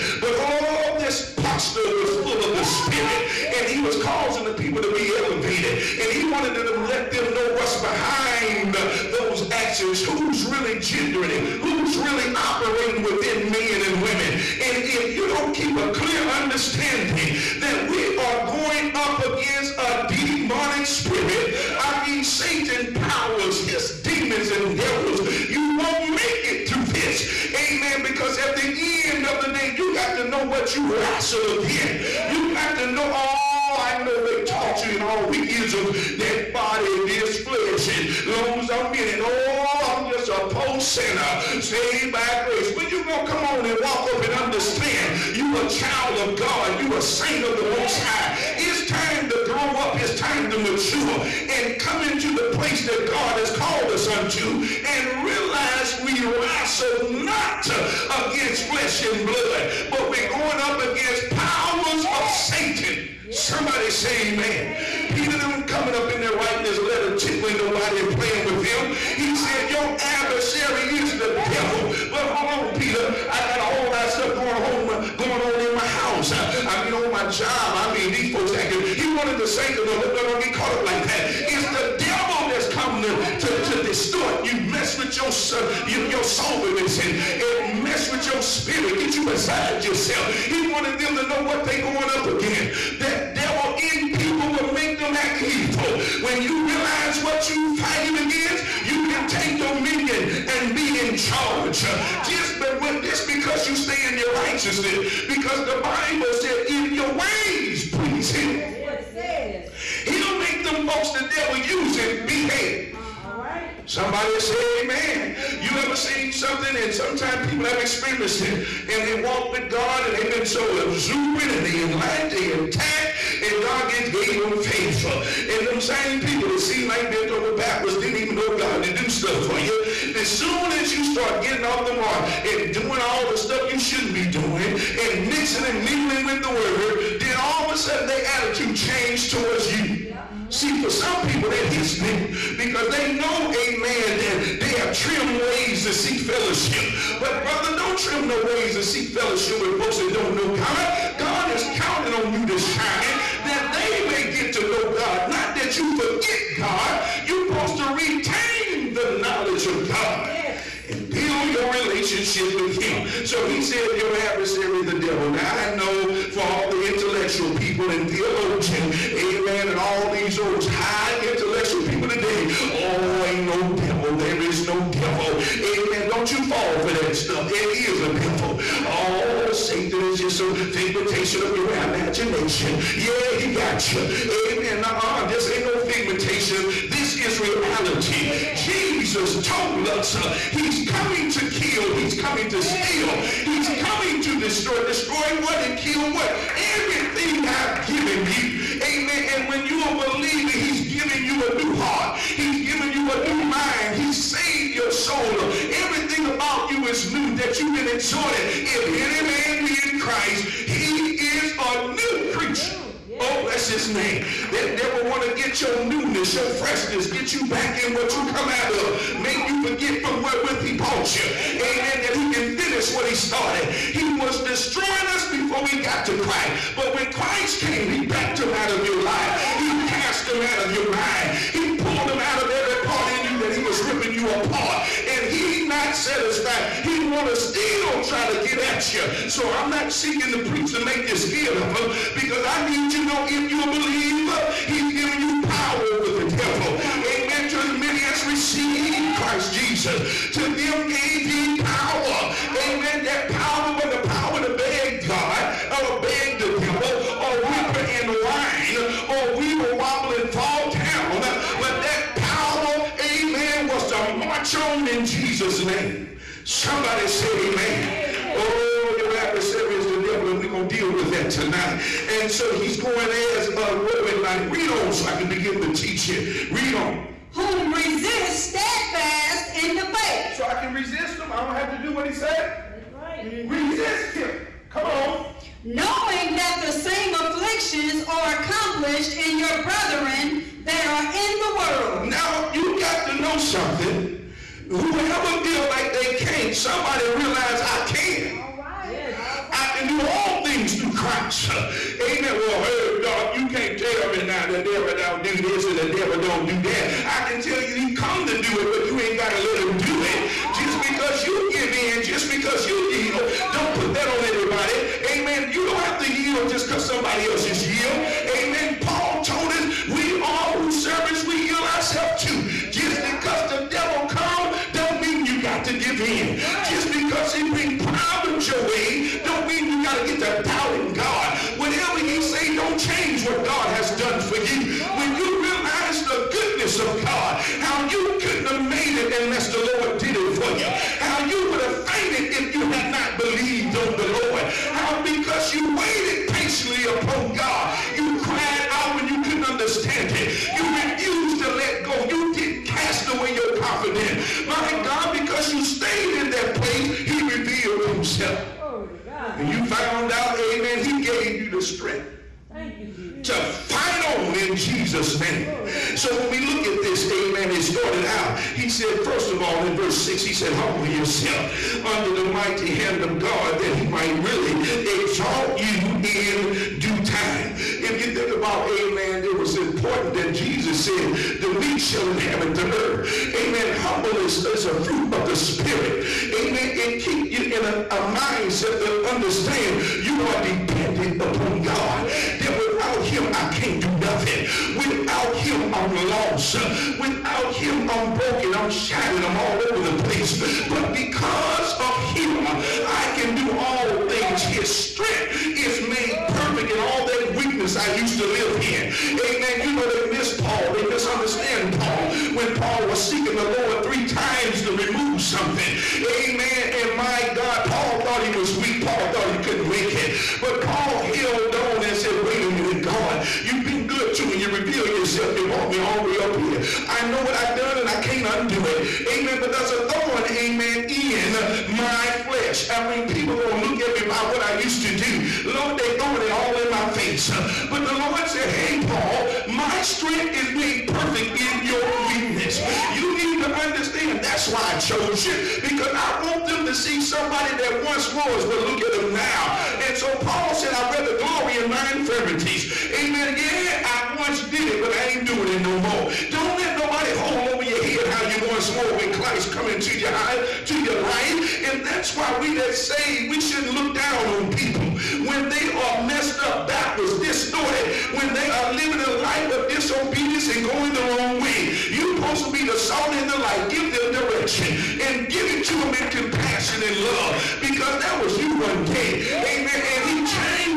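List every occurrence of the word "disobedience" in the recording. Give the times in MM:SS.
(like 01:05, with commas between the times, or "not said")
07:49.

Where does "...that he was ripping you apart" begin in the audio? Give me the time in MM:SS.
03:53.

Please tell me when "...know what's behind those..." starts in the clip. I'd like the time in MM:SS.
00:07.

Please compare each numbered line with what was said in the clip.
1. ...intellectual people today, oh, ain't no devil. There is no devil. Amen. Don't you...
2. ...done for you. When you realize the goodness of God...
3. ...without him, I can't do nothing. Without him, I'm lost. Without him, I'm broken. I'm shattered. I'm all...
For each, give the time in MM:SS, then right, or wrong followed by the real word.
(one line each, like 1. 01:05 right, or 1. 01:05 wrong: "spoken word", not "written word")
1. 02:51 right
2. 05:33 right
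3. 06:32 right.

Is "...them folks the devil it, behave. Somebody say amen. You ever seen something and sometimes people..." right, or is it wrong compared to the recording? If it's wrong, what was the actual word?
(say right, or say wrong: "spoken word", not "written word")
right.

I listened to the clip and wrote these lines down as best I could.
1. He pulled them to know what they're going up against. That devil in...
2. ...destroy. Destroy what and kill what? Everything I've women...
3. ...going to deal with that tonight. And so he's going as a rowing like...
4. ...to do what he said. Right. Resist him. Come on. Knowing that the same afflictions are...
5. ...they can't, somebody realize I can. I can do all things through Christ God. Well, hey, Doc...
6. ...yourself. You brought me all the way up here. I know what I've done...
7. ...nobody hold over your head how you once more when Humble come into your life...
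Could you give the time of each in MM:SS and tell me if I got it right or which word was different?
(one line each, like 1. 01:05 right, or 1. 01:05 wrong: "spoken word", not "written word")
1. 01:30 wrong: "wanted", not "pulled"
2. 03:14 wrong: "given", not "women"
3. 04:30 right
4. 04:41 right
5. 04:55 wrong: "Amen", not "God"
6. 07:04 right
7. 07:36 wrong: "Christ", not "Humble".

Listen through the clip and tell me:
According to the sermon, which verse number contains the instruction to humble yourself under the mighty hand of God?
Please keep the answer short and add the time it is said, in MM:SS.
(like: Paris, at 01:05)
verse 6, at 06:09.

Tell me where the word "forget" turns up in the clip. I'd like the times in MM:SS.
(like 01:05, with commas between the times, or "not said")
02:35, 03:39.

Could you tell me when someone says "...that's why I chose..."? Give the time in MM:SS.
07:24.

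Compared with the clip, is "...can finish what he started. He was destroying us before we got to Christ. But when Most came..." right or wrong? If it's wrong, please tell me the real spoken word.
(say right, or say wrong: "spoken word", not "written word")
wrong: "Christ", not "Most".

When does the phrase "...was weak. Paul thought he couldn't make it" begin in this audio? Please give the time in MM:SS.
06:58.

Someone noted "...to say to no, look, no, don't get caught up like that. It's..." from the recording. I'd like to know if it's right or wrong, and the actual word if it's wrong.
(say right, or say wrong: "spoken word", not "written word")
right.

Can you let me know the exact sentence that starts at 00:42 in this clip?
But you gonna come on and walk up and understand you a child of God, you a saint of the Most High.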